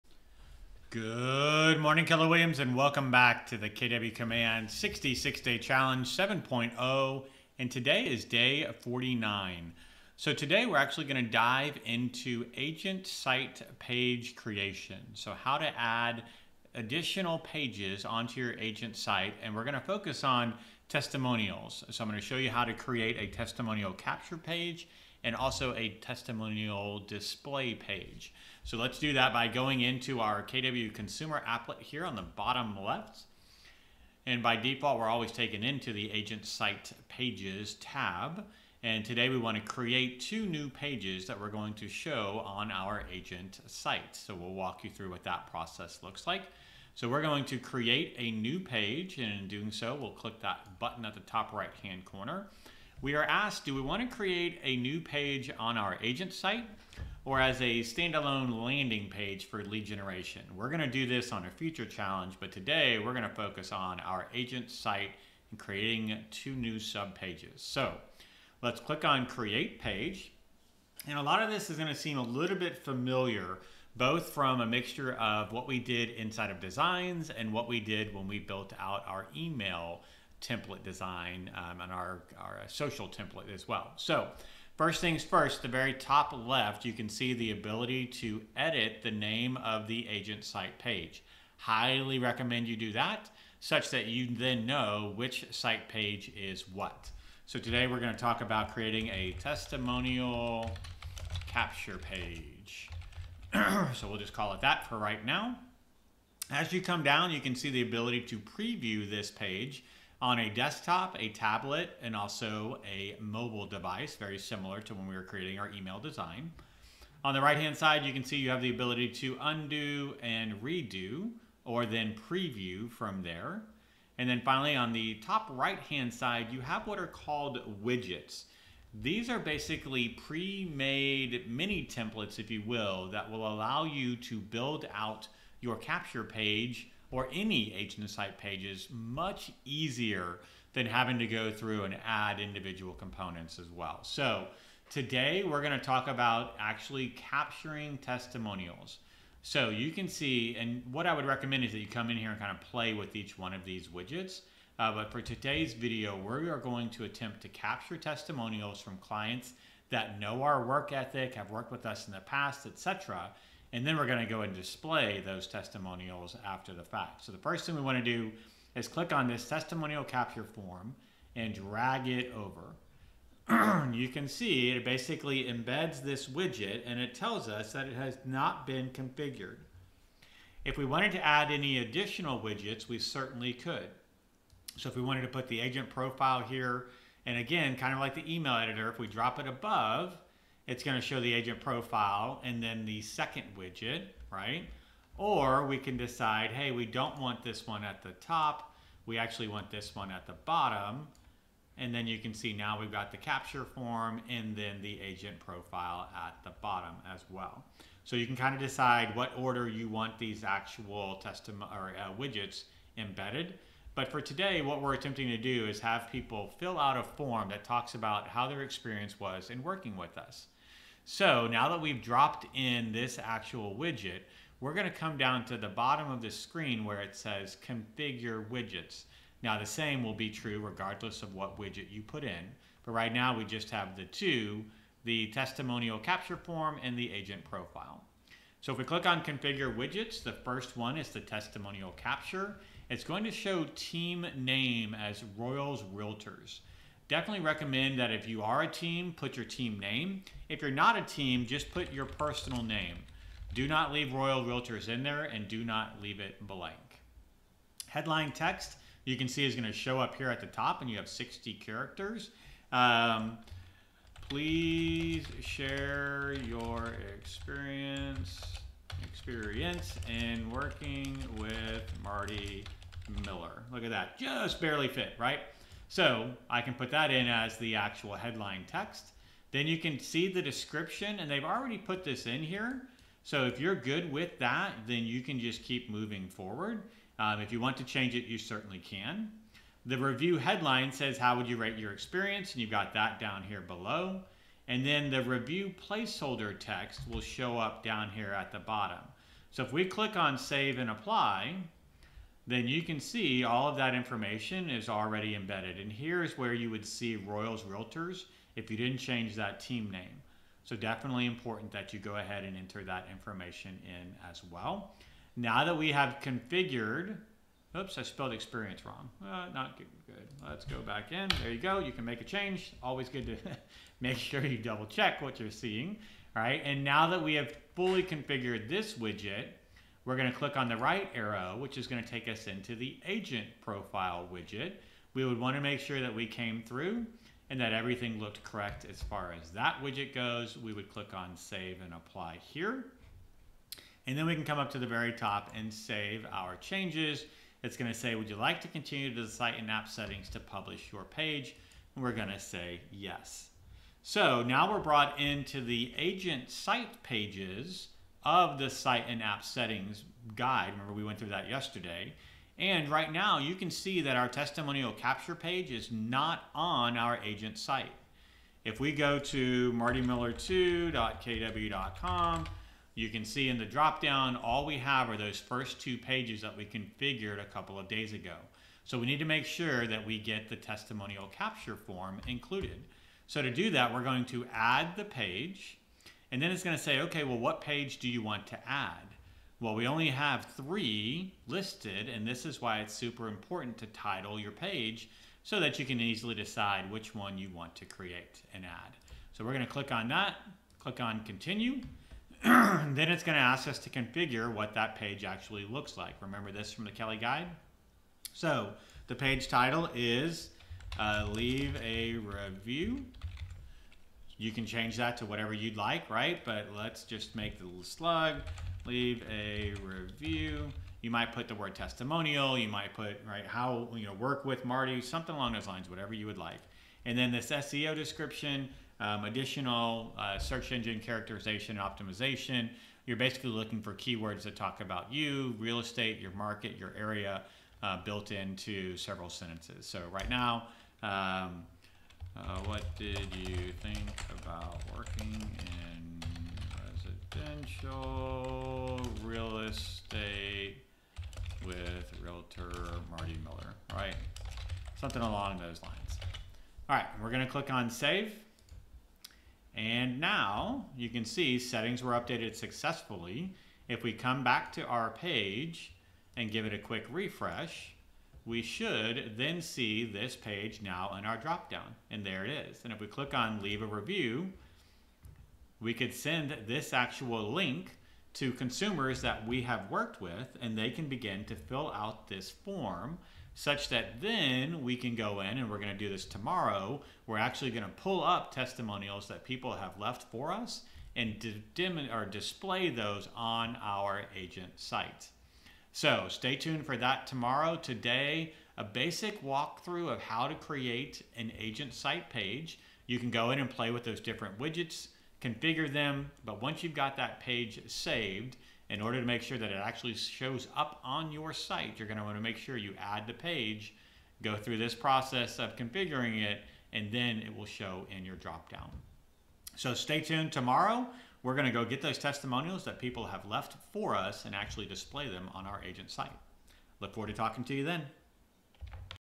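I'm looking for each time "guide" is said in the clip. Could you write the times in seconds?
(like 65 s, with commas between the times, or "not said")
360 s, 407 s.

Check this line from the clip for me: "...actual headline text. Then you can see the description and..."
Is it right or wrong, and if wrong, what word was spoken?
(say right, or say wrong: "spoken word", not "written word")
right.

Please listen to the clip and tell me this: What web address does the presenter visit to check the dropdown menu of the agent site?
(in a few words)
martymiller2.kw.com.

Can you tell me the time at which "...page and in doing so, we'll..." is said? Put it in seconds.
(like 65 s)
48 s.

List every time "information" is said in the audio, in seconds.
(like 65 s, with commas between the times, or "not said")
303 s, 313 s.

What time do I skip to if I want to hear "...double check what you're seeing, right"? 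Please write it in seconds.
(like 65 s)
324 s.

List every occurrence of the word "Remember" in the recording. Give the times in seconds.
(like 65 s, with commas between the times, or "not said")
360 s, 406 s.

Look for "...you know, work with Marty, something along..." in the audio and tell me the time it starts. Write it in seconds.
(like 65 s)
423 s.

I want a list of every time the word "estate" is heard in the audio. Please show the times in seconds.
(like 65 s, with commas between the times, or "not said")
435 s, 449 s.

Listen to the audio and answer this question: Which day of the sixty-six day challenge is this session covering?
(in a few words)
49.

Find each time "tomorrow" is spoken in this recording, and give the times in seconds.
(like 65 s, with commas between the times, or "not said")
486 s, 497 s, 520 s.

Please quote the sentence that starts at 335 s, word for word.
We would want to make sure that we came through and that everything looked correct as far as that widget goes.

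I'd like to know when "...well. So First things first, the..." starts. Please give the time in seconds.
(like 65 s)
83 s.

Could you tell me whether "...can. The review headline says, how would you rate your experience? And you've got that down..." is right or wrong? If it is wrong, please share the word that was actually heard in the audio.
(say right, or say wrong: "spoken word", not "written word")
right.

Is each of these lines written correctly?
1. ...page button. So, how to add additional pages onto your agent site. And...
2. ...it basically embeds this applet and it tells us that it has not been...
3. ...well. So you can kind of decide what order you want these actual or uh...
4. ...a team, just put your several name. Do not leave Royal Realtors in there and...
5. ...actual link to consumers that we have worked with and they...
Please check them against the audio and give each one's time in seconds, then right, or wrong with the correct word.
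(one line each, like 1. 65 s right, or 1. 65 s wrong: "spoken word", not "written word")
1. 13 s wrong: "creation", not "button"
2. 174 s wrong: "widget", not "applet"
3. 207 s right
4. 250 s wrong: "personal", not "several"
5. 476 s right.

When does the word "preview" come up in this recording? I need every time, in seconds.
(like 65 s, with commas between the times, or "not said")
108 s, 122 s.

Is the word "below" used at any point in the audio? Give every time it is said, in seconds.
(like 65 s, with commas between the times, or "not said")
293 s.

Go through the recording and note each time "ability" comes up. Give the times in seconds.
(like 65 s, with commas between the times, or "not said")
87 s, 107 s, 118 s.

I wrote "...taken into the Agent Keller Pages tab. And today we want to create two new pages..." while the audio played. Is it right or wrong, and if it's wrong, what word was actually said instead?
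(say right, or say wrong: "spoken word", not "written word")
wrong: "Site", not "Keller".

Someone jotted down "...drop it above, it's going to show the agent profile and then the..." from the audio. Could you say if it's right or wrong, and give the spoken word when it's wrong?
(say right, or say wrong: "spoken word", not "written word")
right.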